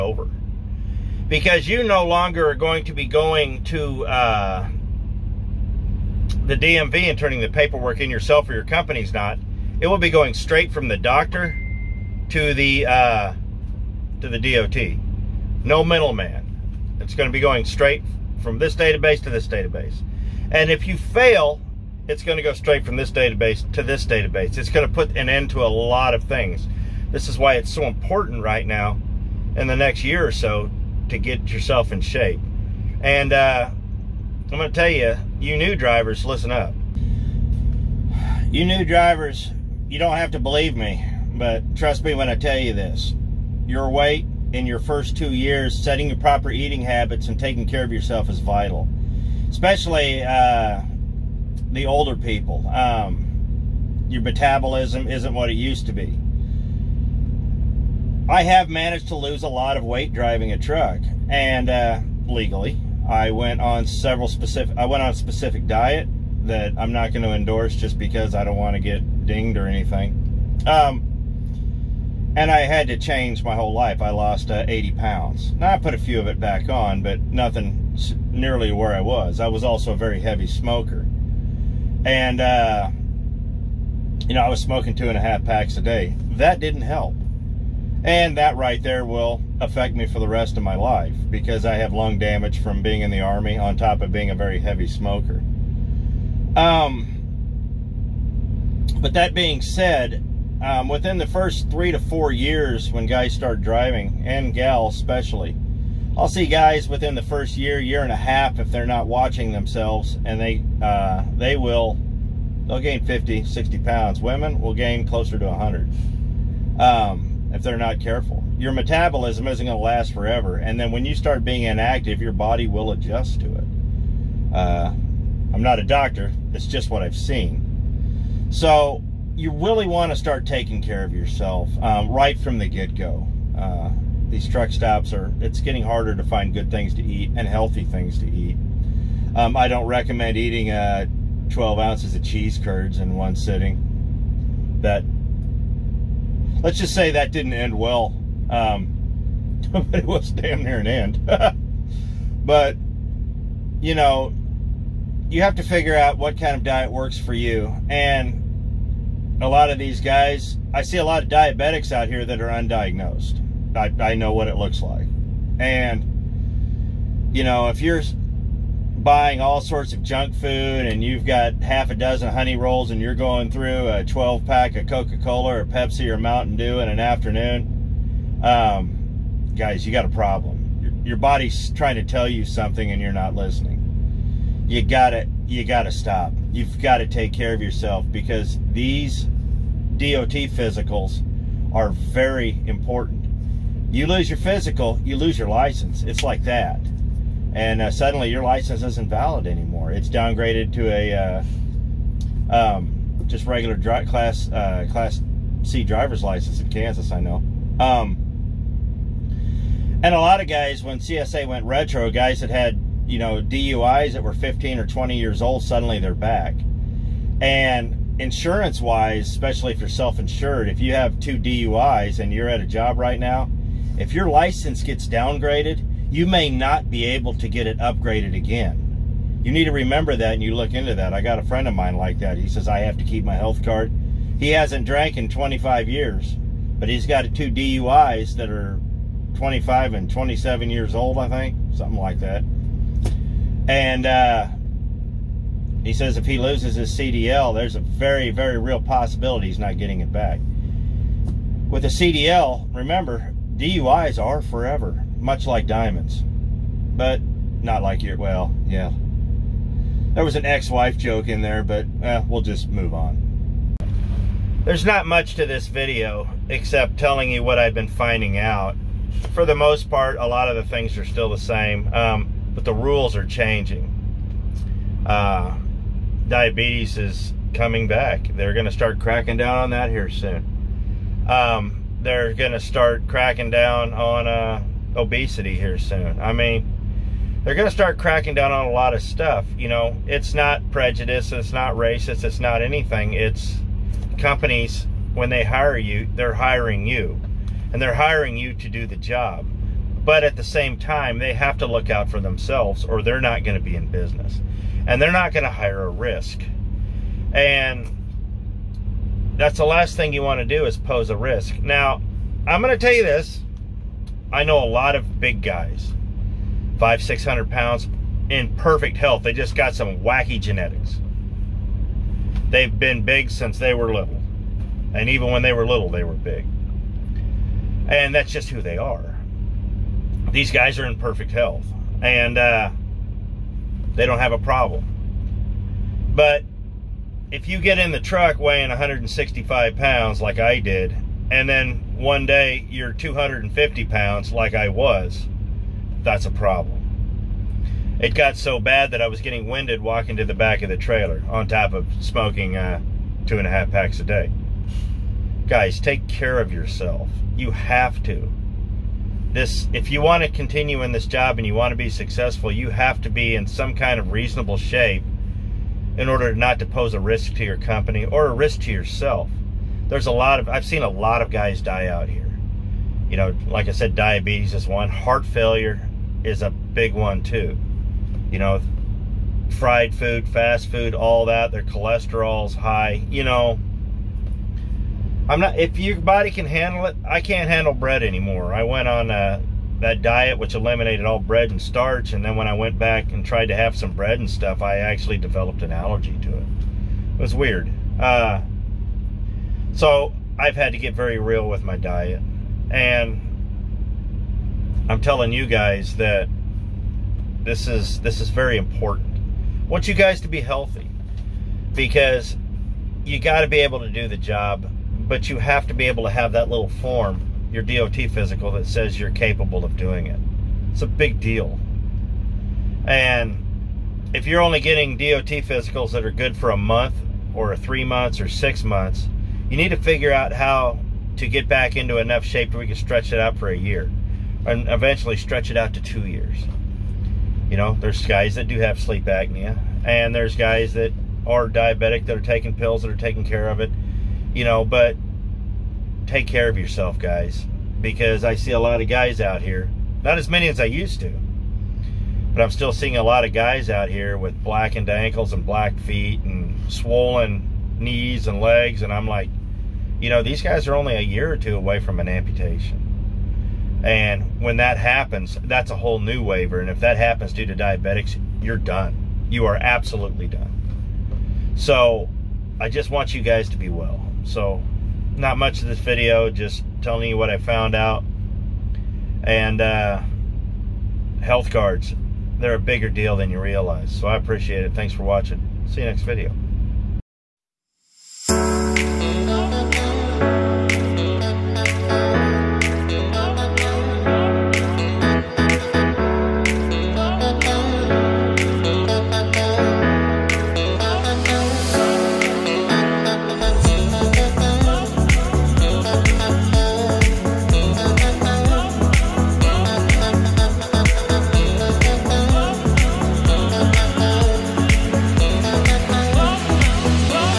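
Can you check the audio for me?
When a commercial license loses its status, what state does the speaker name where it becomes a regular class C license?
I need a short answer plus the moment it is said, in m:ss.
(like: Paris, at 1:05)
Kansas, at 3:26.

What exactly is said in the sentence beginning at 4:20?
There was an ex-wife joke in there, but eh, we'll just move on.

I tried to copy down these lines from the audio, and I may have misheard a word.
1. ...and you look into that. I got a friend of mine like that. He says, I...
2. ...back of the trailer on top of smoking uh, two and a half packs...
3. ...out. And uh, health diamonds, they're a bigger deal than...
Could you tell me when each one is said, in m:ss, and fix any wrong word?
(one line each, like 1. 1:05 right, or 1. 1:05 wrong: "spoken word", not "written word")
1. 3:50 right
2. 5:50 right
3. 7:57 wrong: "cards", not "diamonds".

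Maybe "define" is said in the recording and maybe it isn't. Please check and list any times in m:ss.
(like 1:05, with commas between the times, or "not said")
not said.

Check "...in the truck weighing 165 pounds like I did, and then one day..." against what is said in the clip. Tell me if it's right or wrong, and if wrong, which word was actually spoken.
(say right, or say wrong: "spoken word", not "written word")
right.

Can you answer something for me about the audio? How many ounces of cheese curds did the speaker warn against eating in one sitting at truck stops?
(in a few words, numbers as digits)
12 ounces.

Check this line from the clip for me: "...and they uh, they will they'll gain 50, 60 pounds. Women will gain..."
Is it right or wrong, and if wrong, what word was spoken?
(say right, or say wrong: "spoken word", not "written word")
right.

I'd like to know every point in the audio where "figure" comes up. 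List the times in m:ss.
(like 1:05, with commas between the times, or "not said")
2:35, 7:09.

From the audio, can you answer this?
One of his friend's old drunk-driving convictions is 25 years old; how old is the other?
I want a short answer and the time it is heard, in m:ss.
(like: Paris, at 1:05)
27, at 4:00.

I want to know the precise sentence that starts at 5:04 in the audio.
And they're not going to hire a risk.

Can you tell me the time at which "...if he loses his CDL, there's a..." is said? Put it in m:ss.
4:06.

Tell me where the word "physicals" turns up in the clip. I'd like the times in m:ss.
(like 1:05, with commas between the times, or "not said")
3:10, 3:14, 6:57, 7:05.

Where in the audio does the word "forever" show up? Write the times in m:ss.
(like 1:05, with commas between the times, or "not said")
2:00, 4:14.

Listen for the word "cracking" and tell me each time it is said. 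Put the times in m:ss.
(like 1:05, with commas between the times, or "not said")
4:38, 4:43, 4:47.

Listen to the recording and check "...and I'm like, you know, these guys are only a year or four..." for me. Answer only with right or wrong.
wrong.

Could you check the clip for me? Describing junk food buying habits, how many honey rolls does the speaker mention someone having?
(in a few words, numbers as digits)
Half a dozen.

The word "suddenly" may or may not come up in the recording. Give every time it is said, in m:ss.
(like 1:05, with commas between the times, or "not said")
3:17, 3:35.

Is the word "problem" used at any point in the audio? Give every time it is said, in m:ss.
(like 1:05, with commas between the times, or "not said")
3:00, 5:34, 5:46.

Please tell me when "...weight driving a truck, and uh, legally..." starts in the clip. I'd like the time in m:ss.
0:59.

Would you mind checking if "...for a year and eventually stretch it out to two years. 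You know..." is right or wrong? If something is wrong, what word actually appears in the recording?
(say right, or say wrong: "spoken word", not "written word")
right.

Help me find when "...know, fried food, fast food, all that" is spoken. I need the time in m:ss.
6:18.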